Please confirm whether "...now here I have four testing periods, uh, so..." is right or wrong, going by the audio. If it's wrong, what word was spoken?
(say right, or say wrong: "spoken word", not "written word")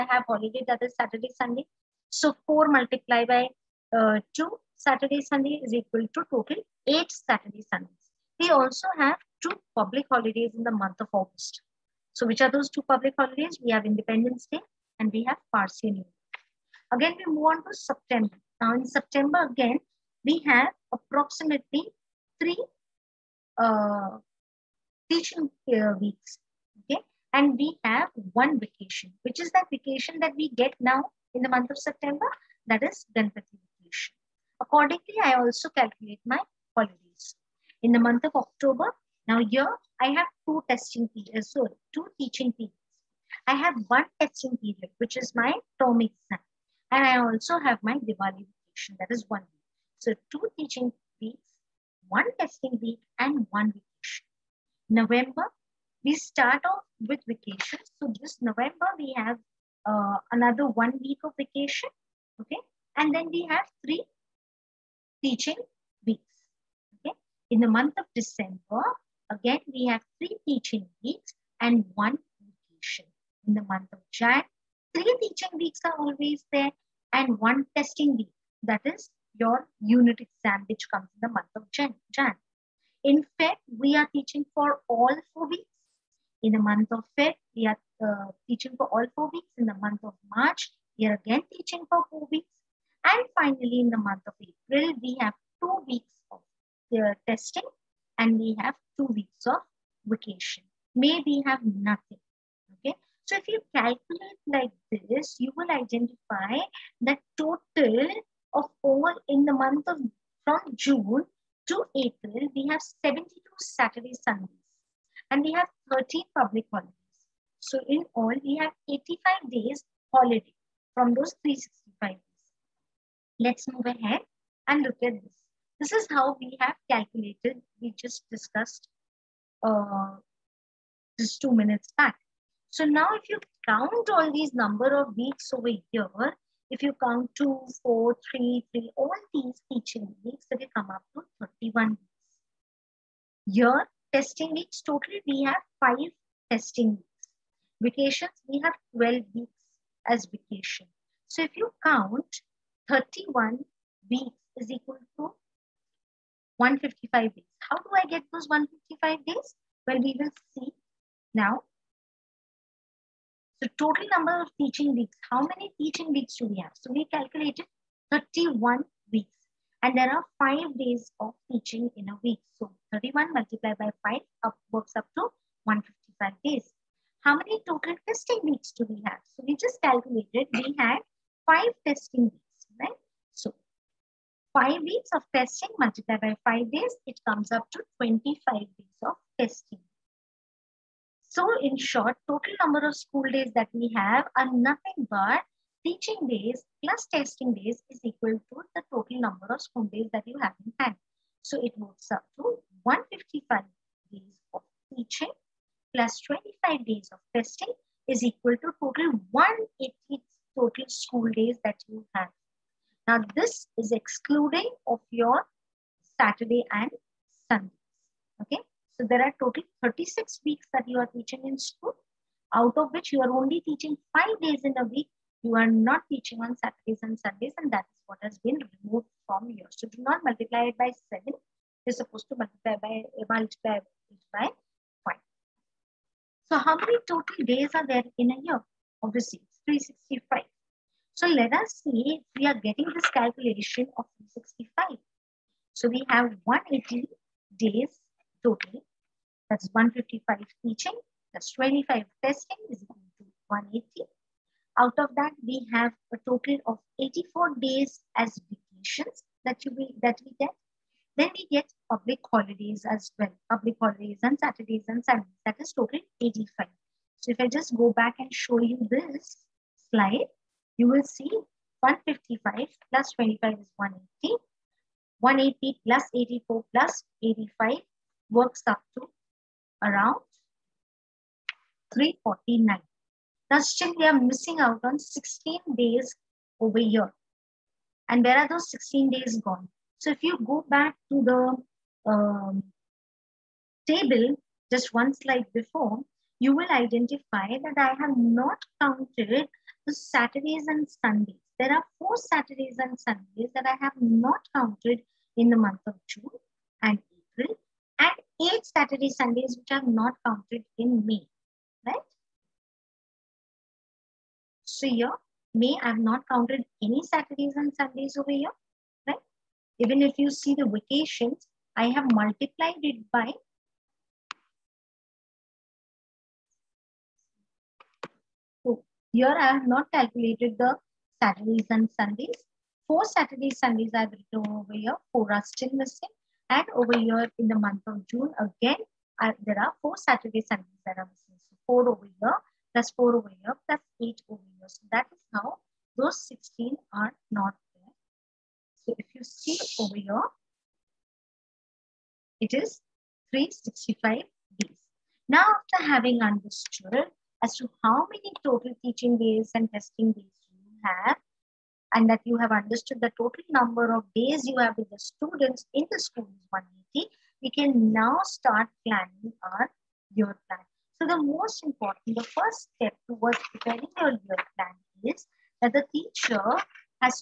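wrong: "two", not "four".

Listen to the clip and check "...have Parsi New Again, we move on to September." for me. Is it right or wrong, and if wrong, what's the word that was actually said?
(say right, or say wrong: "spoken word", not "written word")
right.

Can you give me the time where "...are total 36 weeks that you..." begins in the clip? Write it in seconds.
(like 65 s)
219 s.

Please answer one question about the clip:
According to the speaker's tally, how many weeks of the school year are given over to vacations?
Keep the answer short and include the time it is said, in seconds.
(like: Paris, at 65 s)
12, at 148 s.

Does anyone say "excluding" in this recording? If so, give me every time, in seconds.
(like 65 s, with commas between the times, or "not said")
213 s.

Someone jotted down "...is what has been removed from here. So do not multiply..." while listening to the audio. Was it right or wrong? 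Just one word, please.
right.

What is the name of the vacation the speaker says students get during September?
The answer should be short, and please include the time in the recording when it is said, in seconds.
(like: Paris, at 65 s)
Ganpati vacation, at 33 s.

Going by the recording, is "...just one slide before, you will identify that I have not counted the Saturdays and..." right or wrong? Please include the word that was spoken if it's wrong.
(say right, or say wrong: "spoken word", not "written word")
right.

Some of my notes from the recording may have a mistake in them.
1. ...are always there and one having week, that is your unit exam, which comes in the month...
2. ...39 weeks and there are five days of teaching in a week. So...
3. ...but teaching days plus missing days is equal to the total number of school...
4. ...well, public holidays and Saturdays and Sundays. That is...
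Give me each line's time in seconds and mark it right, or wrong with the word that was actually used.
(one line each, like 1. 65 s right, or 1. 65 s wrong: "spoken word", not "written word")
1. 75 s wrong: "testing", not "having"
2. 168 s wrong: "31", not "39"
3. 195 s wrong: "testing", not "missing"
4. 263 s right.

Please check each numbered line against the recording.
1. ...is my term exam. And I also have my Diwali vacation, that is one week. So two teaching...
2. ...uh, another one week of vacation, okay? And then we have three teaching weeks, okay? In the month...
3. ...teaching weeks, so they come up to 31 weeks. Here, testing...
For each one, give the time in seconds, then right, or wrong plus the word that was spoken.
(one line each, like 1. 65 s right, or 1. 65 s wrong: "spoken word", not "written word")
1. 45 s right
2. 59 s right
3. 139 s right.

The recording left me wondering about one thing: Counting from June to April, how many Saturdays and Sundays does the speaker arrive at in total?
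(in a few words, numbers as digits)
72.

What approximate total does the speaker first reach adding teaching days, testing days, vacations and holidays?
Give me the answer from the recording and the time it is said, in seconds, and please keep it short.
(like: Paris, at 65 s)
349, at 281 s.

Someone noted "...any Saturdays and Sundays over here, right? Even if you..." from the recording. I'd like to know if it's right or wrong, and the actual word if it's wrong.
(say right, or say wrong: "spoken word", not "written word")
right.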